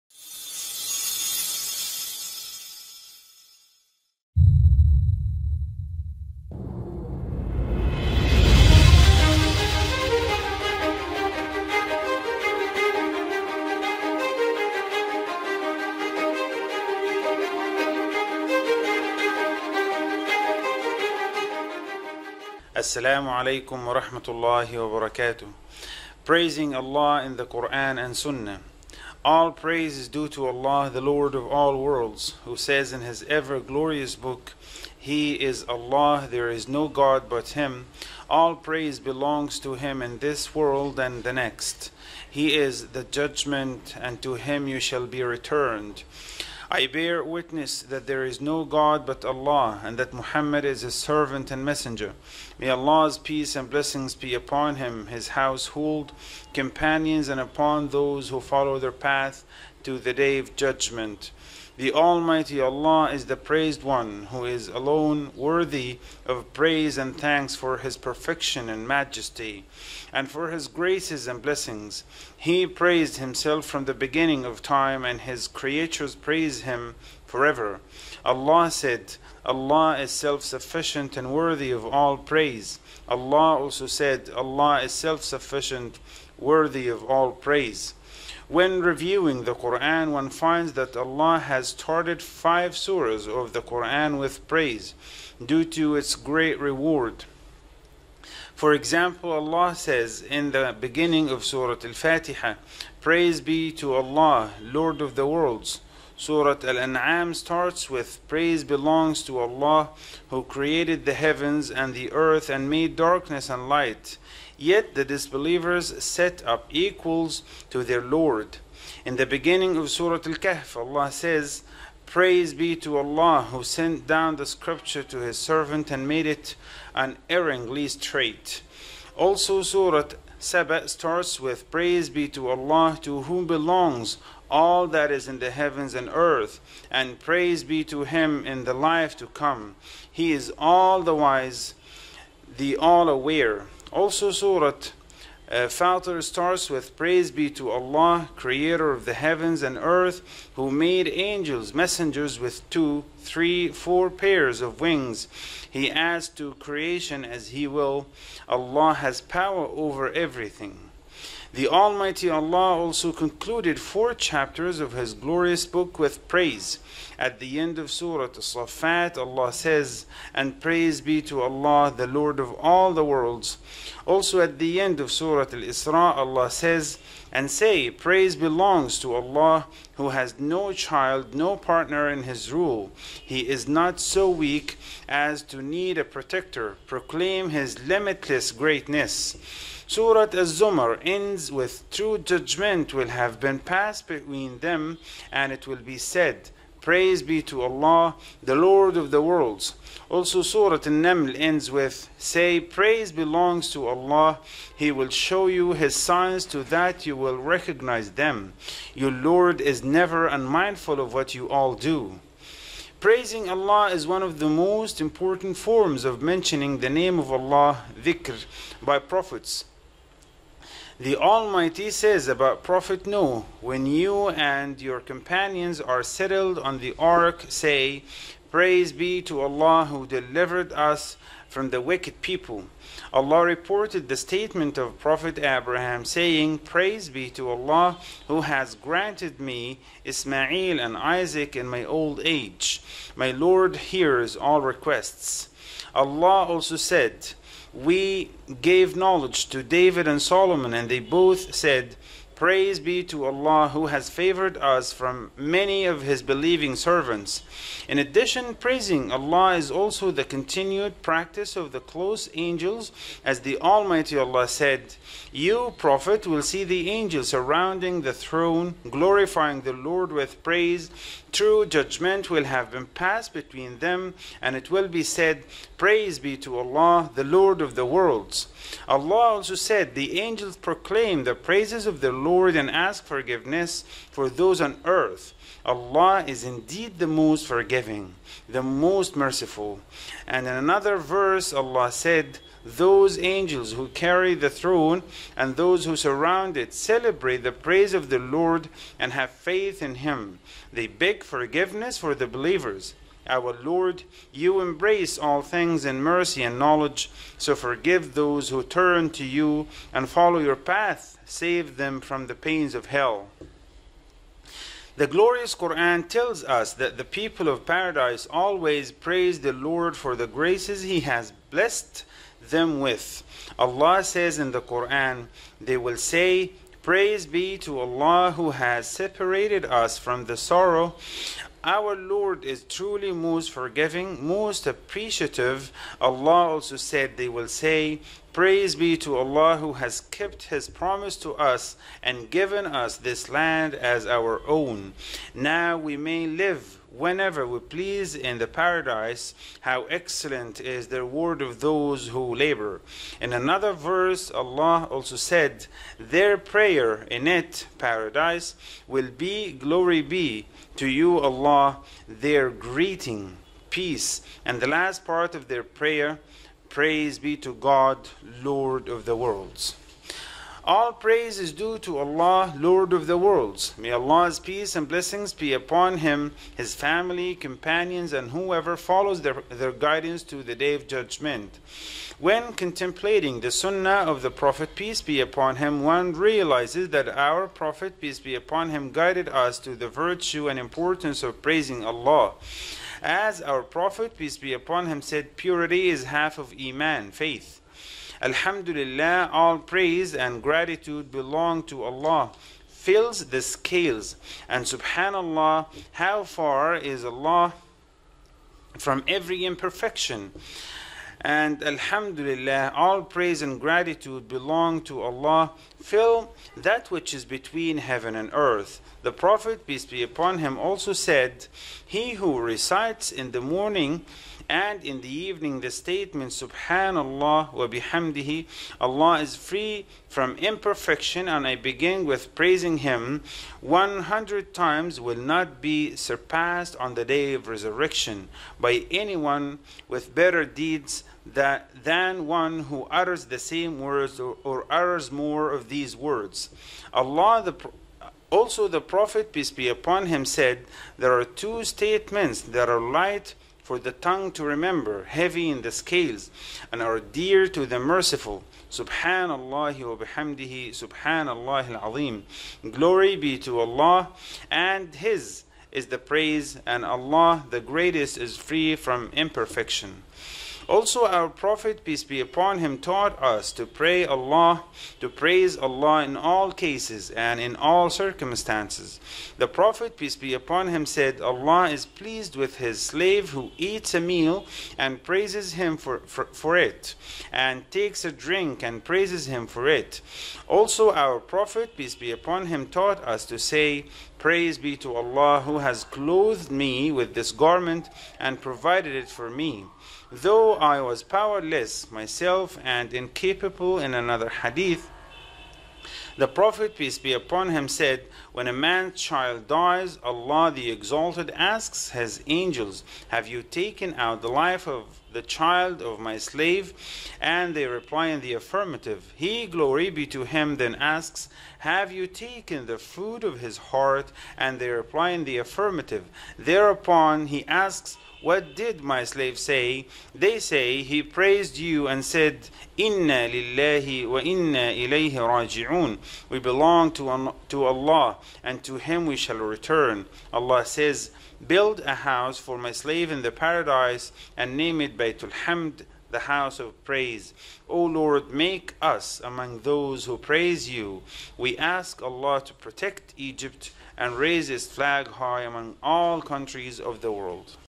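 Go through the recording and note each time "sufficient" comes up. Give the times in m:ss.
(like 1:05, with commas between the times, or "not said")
1:20, 1:24.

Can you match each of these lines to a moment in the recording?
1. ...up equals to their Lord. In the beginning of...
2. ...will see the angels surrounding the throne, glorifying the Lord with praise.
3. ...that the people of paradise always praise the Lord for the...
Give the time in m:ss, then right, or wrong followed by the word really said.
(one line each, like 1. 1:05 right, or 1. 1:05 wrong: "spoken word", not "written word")
1. 1:56 right
2. 4:26 right
3. 5:16 right.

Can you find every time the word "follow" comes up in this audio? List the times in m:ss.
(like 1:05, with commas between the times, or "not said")
0:58, 5:10, 6:18.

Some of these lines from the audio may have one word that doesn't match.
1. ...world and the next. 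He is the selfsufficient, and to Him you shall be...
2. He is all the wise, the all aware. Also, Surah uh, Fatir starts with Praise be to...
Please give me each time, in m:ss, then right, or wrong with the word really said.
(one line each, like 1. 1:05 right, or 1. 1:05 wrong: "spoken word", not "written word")
1. 0:40 wrong: "judgment", not "selfsufficient"
2. 2:20 right.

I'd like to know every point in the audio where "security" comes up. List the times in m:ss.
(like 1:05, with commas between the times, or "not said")
not said.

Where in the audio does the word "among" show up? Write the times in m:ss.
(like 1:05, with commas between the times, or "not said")
9:09, 9:15.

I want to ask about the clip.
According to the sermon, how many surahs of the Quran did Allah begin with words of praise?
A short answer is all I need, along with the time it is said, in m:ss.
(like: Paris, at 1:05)
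5, at 1:32.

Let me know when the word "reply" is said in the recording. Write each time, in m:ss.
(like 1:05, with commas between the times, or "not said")
8:37, 8:44.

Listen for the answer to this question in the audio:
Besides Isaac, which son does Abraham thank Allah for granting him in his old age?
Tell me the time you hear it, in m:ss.
4:00.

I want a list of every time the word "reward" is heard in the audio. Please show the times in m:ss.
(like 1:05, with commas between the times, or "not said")
1:36, 5:51.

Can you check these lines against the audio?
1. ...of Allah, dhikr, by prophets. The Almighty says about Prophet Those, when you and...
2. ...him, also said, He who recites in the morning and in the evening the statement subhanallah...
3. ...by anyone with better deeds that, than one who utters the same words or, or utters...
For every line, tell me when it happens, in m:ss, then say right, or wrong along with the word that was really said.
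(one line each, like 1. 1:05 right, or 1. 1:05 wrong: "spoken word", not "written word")
1. 3:37 wrong: "Noah", not "Those"
2. 7:00 right
3. 7:18 right.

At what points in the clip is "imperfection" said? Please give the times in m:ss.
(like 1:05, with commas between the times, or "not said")
6:49, 7:10, 7:49.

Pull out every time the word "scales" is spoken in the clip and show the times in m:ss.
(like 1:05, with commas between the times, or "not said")
6:43, 7:35.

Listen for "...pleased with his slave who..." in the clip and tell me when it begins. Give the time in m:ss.
8:01.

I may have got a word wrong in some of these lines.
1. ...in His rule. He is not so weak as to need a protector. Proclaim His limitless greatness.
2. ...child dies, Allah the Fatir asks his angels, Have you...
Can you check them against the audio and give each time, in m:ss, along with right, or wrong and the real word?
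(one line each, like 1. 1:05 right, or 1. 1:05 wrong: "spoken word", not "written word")
1. 3:02 right
2. 8:29 wrong: "Exalted", not "Fatir".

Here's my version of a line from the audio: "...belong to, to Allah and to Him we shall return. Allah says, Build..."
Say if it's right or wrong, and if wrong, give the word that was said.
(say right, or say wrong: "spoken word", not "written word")
right.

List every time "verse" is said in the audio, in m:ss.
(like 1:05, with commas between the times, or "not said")
4:50, 5:53.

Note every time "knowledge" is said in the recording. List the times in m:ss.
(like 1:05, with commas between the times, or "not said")
4:08, 5:06.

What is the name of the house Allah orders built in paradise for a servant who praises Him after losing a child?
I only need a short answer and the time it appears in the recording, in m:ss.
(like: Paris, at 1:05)
Baytul Hamd, at 9:05.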